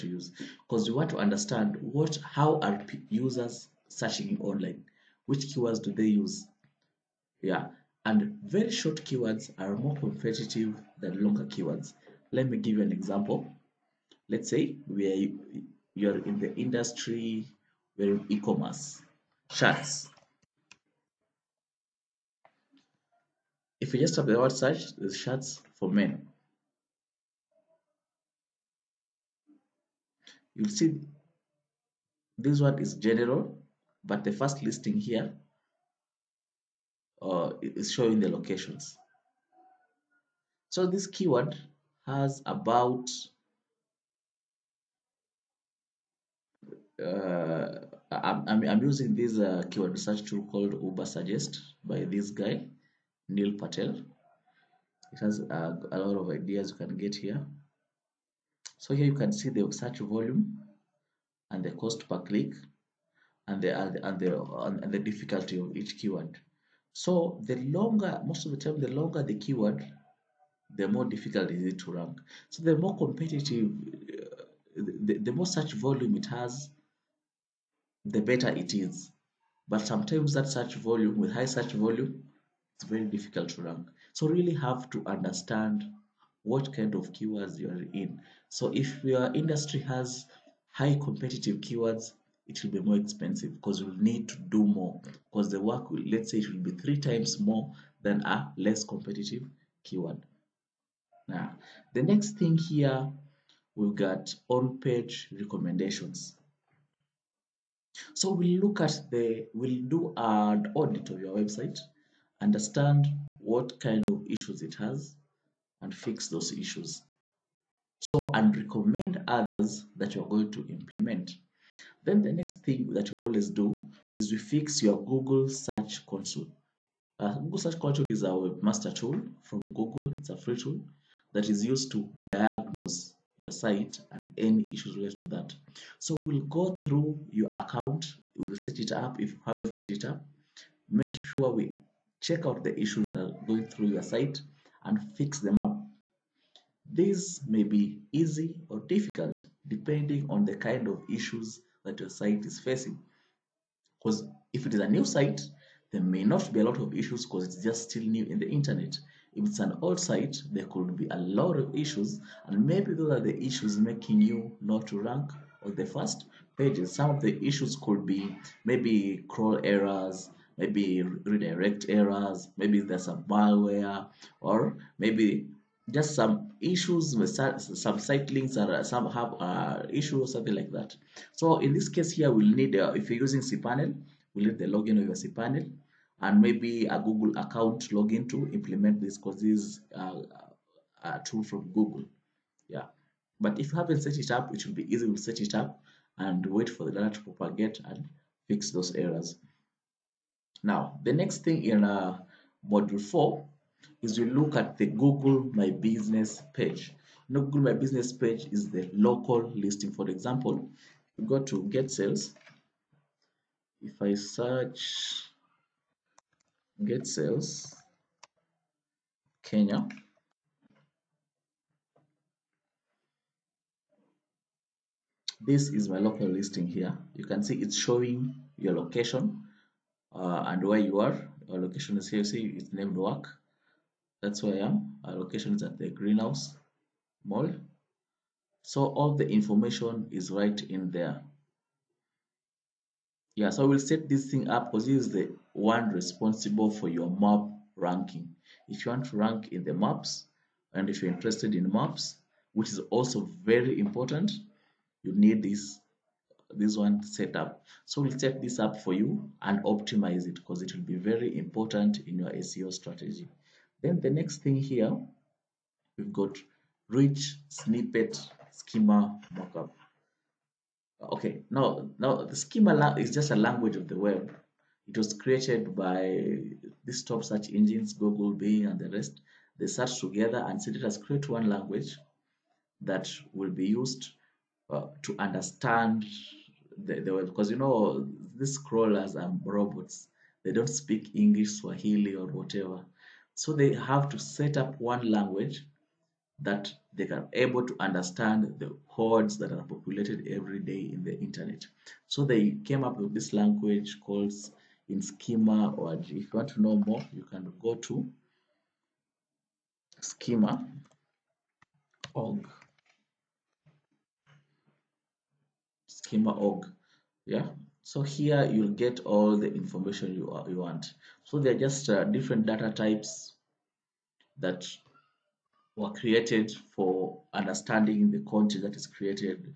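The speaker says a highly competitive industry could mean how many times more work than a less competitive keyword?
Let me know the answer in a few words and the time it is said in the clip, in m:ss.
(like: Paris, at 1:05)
3 times, at 1:36.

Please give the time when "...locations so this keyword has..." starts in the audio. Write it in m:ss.
0:38.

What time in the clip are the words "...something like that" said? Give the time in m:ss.
3:00.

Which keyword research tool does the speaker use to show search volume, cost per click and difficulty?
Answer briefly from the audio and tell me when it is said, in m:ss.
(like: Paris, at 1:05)
Ubersuggest, at 0:50.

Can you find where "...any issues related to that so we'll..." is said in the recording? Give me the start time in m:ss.
2:14.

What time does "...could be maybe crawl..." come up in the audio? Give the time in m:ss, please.
2:47.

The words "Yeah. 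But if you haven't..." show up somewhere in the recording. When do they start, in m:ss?
3:12.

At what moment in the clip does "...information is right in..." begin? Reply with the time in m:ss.
3:59.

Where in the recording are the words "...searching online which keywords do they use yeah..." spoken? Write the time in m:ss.
0:03.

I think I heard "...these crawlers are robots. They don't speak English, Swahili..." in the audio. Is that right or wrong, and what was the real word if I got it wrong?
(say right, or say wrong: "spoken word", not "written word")
right.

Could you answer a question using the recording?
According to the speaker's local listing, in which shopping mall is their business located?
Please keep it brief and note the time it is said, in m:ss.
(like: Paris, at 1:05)
Greenhouse Mall, at 3:55.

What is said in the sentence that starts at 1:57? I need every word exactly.
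So, and recommend others that you're going to implement.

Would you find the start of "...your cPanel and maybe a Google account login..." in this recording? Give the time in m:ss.
3:05.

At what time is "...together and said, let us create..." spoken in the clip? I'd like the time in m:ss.
4:39.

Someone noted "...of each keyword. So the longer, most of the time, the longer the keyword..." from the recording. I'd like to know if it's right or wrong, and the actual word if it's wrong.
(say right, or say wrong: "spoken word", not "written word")
right.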